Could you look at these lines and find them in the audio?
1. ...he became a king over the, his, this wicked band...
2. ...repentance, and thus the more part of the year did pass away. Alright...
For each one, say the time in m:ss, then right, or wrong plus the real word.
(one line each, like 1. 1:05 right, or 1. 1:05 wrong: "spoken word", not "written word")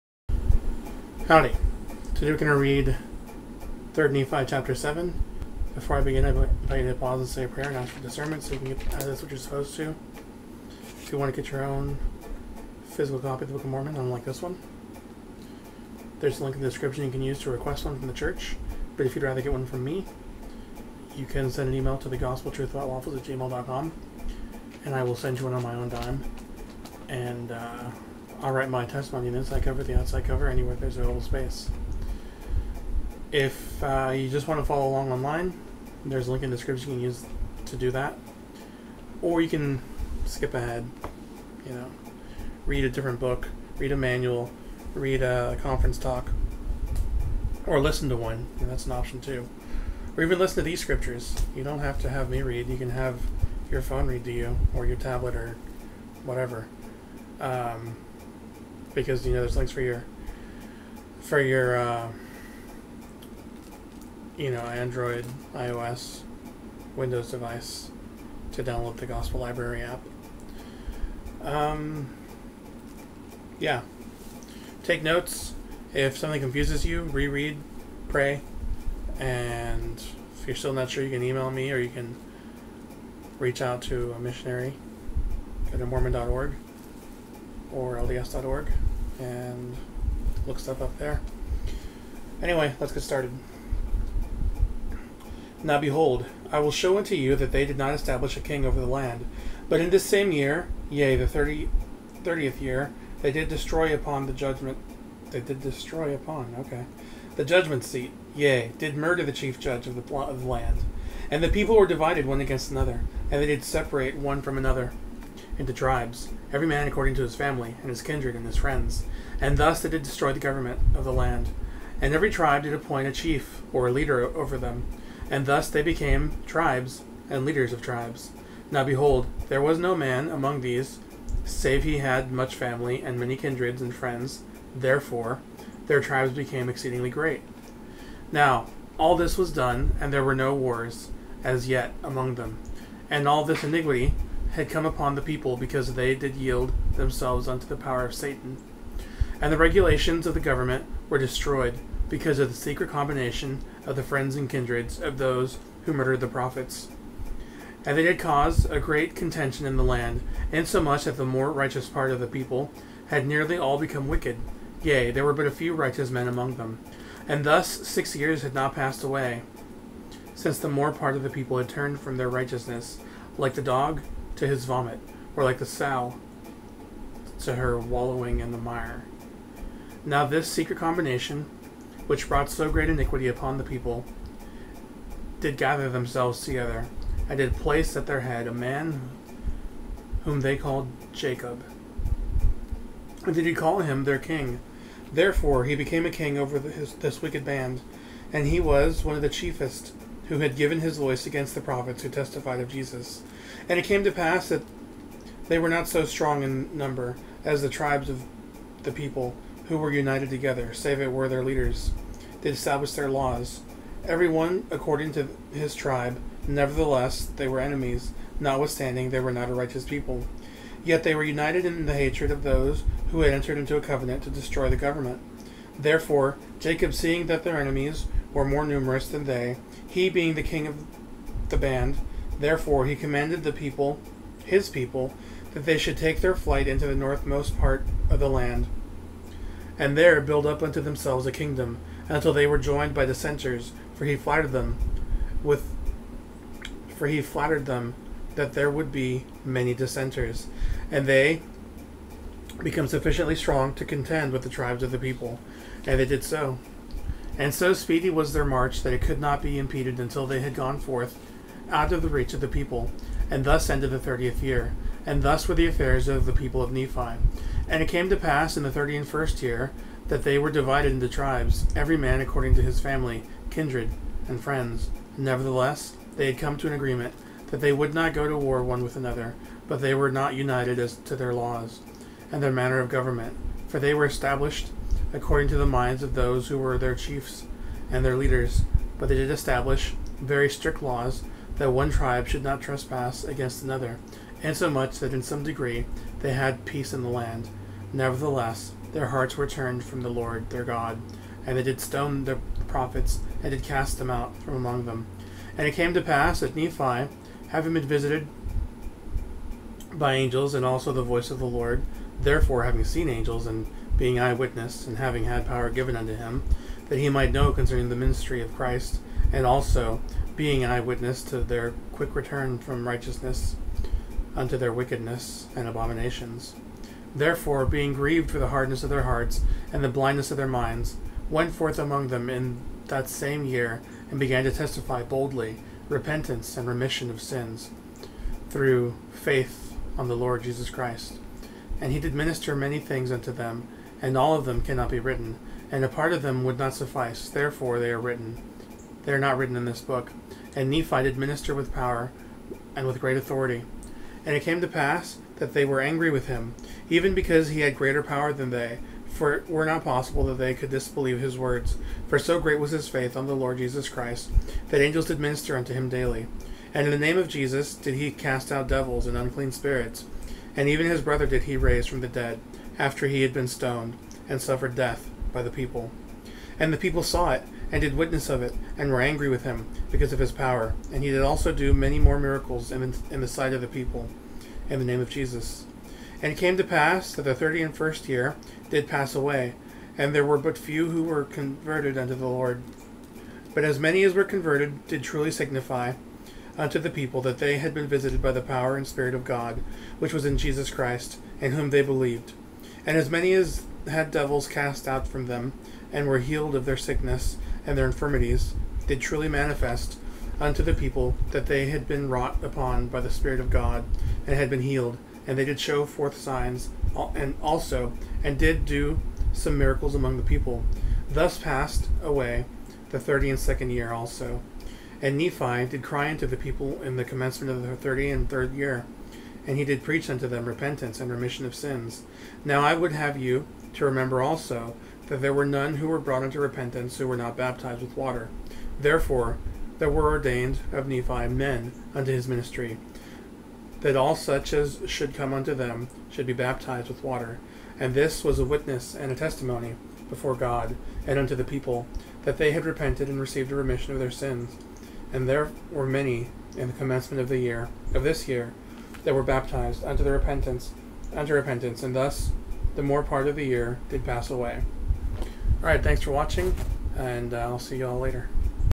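1. 3:15 right
2. 7:41 right.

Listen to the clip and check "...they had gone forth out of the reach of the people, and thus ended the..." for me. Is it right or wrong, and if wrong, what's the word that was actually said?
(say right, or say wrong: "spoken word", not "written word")
right.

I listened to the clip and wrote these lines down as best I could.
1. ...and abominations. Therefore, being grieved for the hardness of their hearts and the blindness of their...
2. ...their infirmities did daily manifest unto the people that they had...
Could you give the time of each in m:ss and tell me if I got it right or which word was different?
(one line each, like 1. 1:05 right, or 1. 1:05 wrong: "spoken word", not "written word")
1. 5:25 right
2. 6:47 wrong: "truly", not "daily".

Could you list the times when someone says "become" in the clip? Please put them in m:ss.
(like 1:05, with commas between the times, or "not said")
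2:43, 4:12.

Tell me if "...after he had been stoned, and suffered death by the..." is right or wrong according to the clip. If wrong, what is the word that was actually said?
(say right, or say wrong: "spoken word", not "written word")
right.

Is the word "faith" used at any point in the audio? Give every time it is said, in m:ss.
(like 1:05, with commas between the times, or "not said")
5:39, 6:02.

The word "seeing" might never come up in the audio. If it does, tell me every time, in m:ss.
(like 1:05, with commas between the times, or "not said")
3:46.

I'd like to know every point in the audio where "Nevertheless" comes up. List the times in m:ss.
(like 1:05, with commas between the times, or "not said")
3:36, 4:35, 4:57.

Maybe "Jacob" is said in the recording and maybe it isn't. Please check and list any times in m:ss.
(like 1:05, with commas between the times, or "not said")
3:11, 3:46.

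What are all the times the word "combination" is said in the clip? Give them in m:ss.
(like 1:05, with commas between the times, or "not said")
2:32, 3:00.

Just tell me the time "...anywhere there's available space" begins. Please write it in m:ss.
0:30.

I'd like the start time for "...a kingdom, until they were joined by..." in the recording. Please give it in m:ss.
4:01.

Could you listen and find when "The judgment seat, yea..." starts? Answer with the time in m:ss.
1:47.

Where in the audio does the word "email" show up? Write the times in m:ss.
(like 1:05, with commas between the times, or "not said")
0:21, 1:21.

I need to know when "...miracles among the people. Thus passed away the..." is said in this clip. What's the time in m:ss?
6:59.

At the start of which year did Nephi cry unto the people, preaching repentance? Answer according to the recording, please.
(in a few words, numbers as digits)
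33rd year.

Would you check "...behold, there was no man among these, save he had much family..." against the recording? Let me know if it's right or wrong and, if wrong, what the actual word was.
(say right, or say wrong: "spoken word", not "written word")
right.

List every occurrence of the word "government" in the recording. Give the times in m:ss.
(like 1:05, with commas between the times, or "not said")
2:00, 2:30, 3:44, 4:42.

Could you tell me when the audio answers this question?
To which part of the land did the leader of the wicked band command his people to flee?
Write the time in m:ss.
3:56.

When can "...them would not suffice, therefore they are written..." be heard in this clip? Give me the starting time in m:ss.
5:46.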